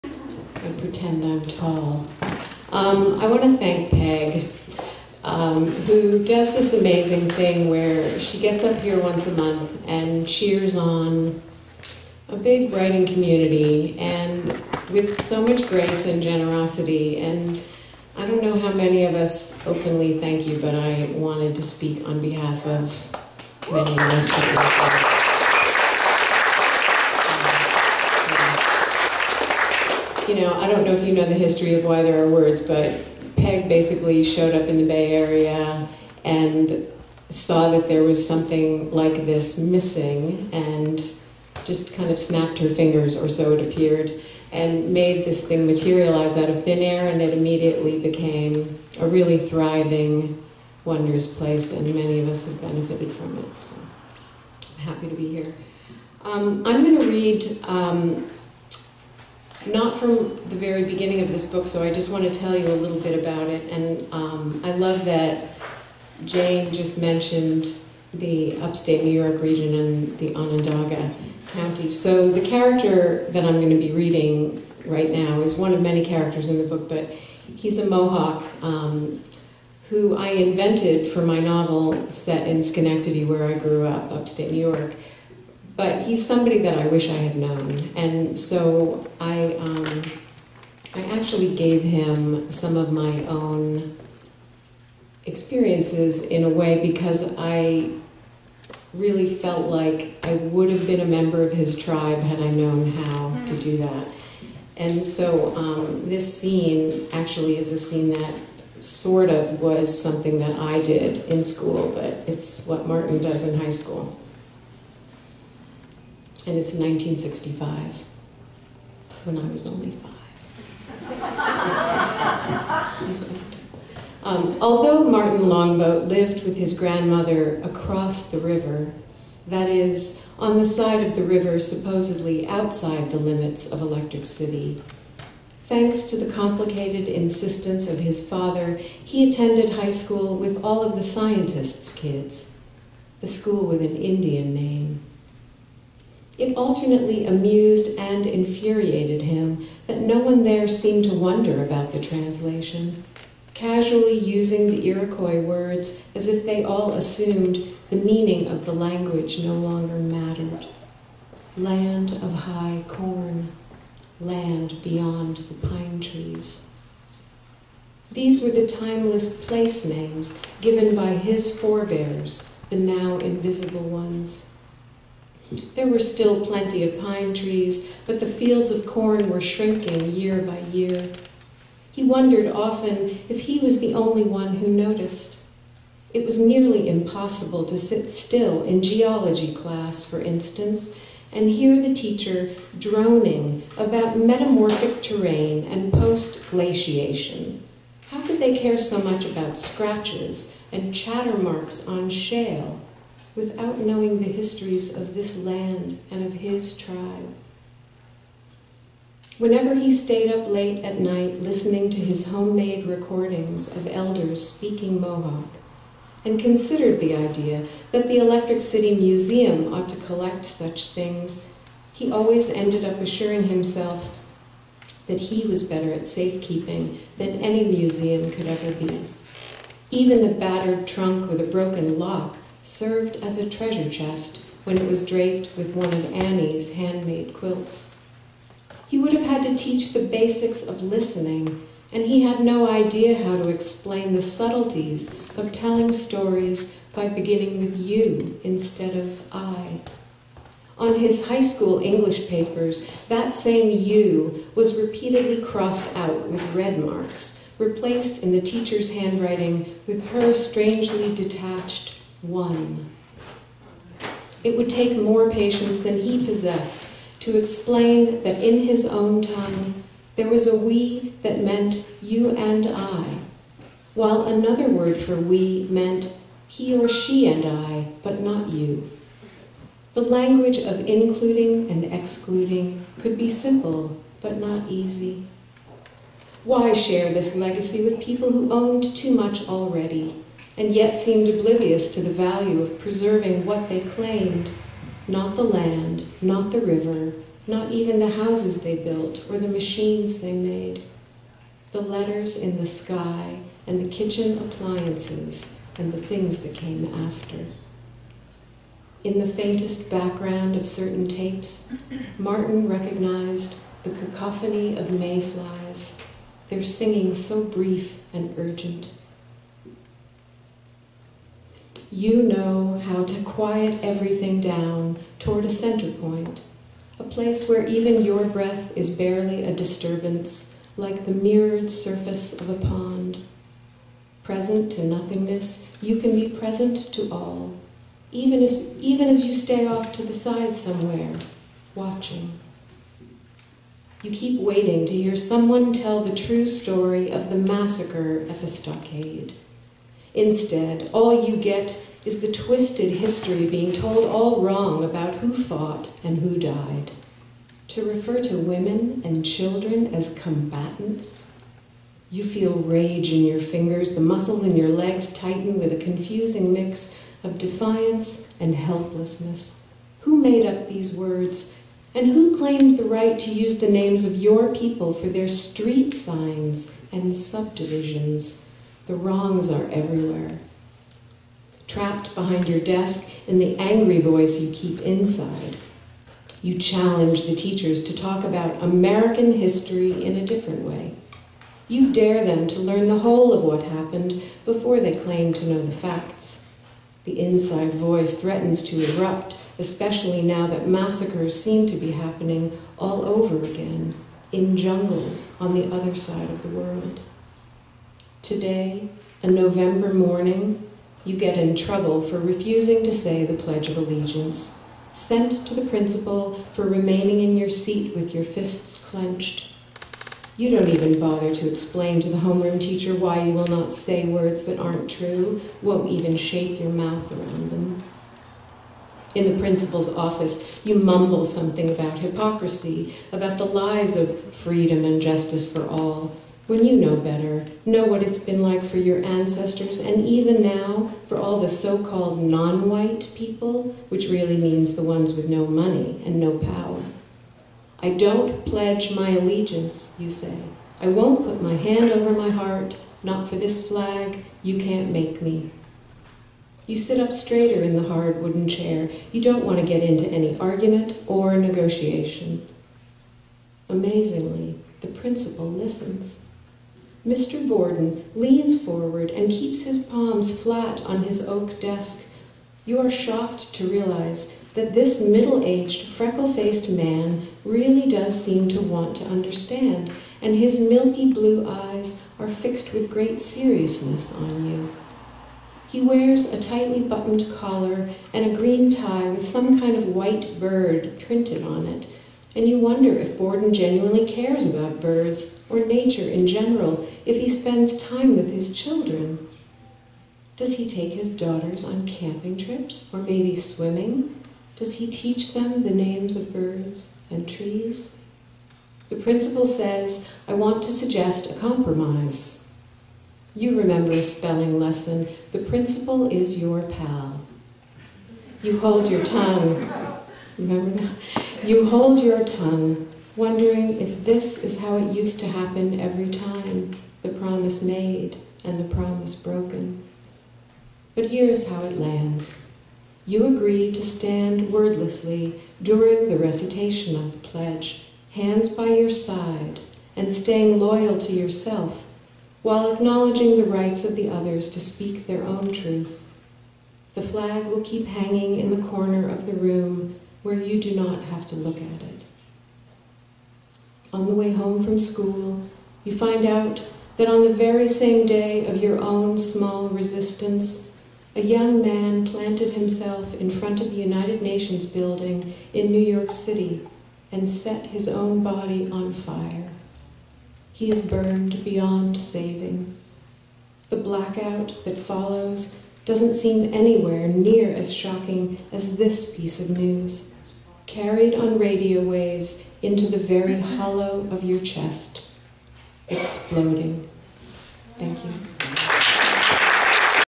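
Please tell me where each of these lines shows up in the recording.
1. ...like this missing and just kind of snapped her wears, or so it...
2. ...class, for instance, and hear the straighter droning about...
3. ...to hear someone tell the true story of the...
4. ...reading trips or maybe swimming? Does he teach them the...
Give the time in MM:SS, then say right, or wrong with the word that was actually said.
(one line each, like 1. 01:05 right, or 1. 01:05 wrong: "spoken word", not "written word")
1. 00:38 wrong: "fingers", not "wears"
2. 03:09 wrong: "teacher", not "straighter"
3. 05:44 right
4. 08:21 wrong: "camping", not "reading".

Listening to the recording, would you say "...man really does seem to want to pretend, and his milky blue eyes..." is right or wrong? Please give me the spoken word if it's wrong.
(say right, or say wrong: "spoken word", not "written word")
wrong: "understand", not "pretend".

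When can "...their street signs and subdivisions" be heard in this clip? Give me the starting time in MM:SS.
06:15.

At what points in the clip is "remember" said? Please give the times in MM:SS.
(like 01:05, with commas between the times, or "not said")
08:33, 08:40.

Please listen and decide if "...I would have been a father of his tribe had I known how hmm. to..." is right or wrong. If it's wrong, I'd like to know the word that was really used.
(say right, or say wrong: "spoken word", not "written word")
wrong: "member", not "father".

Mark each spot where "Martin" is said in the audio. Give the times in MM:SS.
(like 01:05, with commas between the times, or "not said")
01:52, 02:05, 05:12.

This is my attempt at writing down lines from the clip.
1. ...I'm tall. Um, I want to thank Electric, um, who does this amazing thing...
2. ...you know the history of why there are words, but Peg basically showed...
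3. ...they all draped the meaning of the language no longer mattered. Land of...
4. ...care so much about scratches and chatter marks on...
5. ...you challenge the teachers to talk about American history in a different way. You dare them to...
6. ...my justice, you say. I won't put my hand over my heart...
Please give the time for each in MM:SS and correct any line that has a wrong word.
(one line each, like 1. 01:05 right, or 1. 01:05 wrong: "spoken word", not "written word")
1. 00:01 wrong: "Peg", not "Electric"
2. 00:31 right
3. 02:36 wrong: "assumed", not "draped"
4. 03:18 right
5. 06:26 right
6. 07:28 wrong: "allegiance", not "justice".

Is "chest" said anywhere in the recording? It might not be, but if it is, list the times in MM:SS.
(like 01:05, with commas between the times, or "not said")
03:53, 09:44.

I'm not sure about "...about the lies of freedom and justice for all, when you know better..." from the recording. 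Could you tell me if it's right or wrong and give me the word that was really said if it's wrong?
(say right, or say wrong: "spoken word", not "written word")
right.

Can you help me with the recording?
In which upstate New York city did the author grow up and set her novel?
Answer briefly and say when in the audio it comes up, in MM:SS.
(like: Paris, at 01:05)
Schenectady, at 01:22.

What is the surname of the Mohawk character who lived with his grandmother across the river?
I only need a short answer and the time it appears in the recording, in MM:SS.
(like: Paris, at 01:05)
Longboat, at 02:05.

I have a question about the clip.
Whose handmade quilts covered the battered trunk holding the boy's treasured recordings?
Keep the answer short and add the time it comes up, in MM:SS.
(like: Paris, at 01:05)
Annie, at 03:56.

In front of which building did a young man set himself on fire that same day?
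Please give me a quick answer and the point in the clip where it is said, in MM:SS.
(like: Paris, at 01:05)
United Nations building, at 09:23.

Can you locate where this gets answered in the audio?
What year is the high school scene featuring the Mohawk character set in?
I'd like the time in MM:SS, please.
01:56.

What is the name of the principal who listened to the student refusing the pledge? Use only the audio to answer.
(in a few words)
Mr. Borden.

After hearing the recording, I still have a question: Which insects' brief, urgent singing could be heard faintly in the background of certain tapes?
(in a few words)
mayflies.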